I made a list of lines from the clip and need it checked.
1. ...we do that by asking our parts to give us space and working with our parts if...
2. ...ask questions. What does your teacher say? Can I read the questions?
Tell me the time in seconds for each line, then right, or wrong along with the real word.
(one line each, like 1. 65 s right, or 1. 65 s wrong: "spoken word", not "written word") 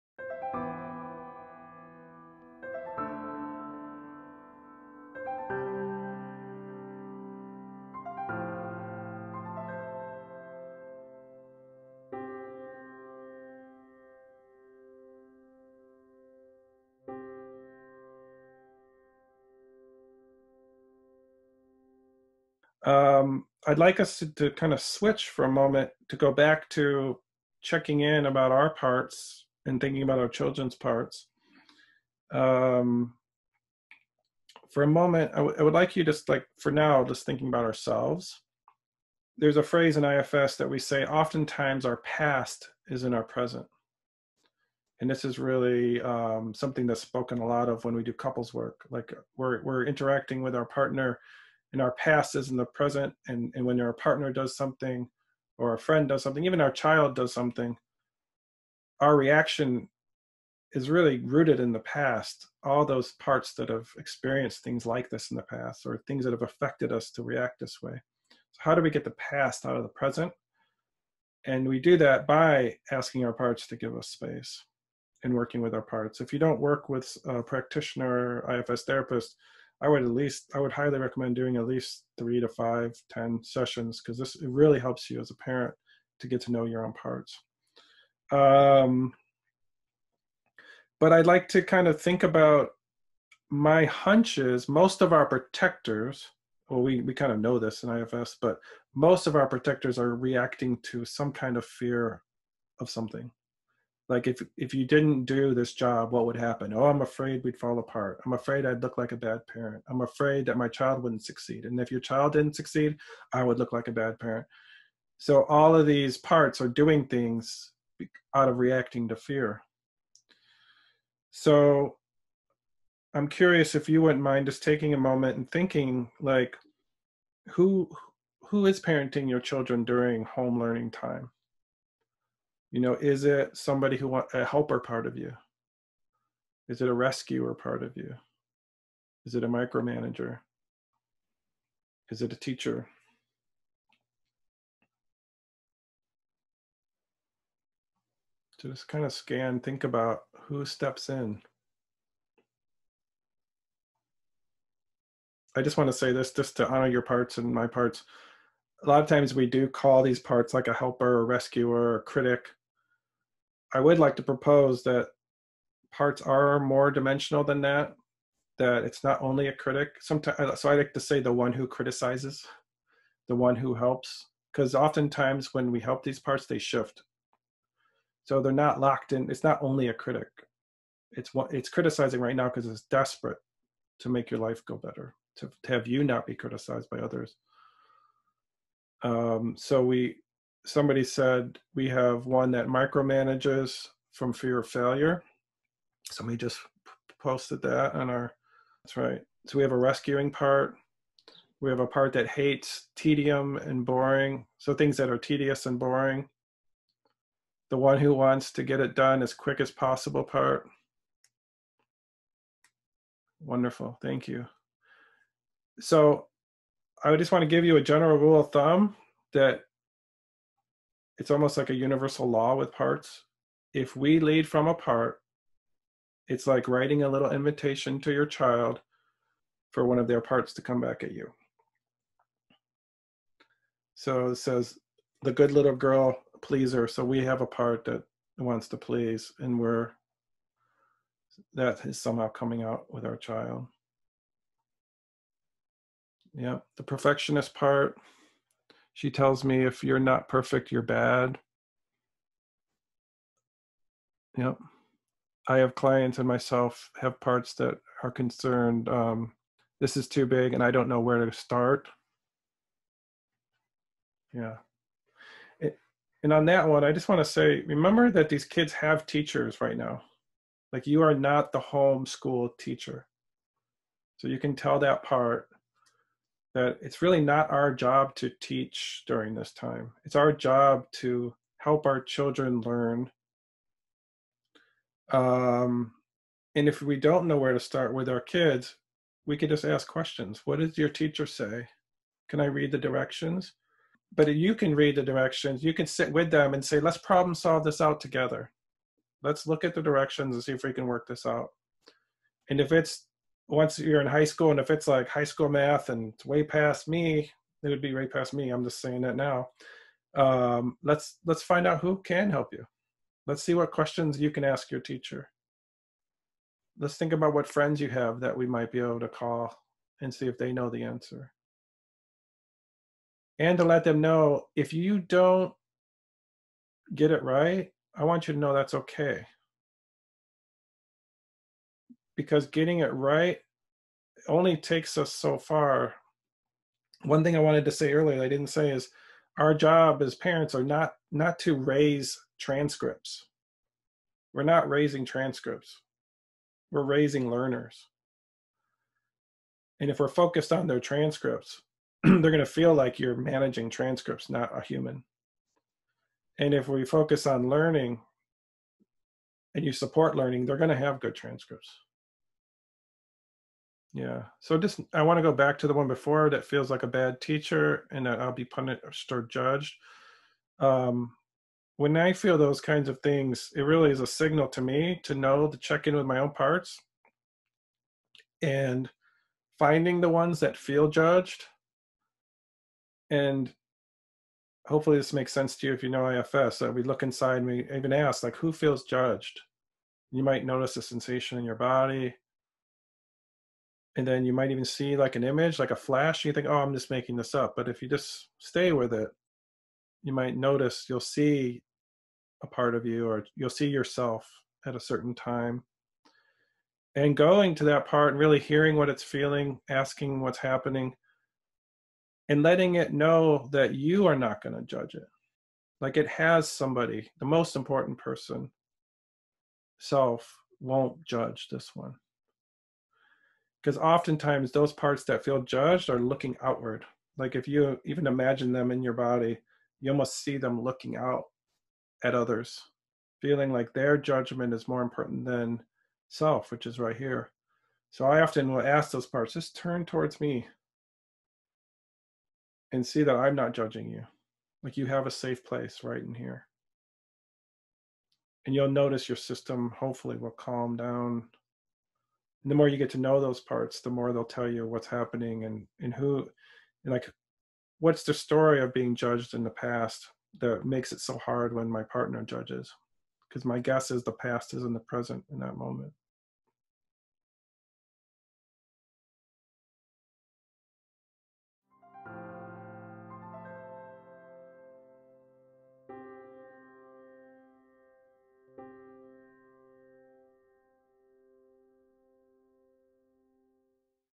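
1. 71 s right
2. 289 s wrong: "directions", not "questions".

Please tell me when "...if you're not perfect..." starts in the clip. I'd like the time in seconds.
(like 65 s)
249 s.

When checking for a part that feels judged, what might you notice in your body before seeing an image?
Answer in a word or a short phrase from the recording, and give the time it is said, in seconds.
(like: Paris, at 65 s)
a sensation, at 390 s.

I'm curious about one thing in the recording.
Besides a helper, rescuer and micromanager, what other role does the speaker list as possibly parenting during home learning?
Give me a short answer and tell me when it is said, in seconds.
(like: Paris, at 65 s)
a teacher, at 142 s.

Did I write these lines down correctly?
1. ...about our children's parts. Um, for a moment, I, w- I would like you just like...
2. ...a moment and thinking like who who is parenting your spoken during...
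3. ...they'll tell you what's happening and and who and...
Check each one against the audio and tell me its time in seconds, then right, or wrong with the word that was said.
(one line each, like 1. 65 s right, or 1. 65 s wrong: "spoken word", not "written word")
1. 30 s right
2. 124 s wrong: "children", not "spoken"
3. 454 s right.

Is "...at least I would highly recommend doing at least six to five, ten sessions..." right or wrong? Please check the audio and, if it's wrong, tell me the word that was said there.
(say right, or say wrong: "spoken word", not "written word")
wrong: "three", not "six".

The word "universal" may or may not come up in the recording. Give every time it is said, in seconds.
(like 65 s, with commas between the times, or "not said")
221 s.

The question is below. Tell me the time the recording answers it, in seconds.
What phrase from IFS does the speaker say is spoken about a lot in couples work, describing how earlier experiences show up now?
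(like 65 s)
41 s.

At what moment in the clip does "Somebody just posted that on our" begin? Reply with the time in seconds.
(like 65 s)
196 s.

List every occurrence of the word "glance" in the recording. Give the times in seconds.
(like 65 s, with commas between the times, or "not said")
not said.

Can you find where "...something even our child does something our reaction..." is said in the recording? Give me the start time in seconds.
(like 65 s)
56 s.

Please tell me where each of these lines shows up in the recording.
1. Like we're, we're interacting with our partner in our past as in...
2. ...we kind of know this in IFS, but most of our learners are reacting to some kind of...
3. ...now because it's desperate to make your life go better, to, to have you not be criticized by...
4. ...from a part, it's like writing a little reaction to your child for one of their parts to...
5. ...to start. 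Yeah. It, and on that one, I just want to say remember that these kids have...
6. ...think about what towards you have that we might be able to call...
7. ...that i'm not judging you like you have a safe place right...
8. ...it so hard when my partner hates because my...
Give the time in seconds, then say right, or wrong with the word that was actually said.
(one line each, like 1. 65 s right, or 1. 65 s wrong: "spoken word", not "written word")
1. 48 s right
2. 97 s wrong: "protectors", not "learners"
3. 182 s right
4. 224 s wrong: "invitation", not "reaction"
5. 261 s right
6. 316 s wrong: "friends", not "towards"
7. 443 s right
8. 460 s wrong: "judges", not "hates".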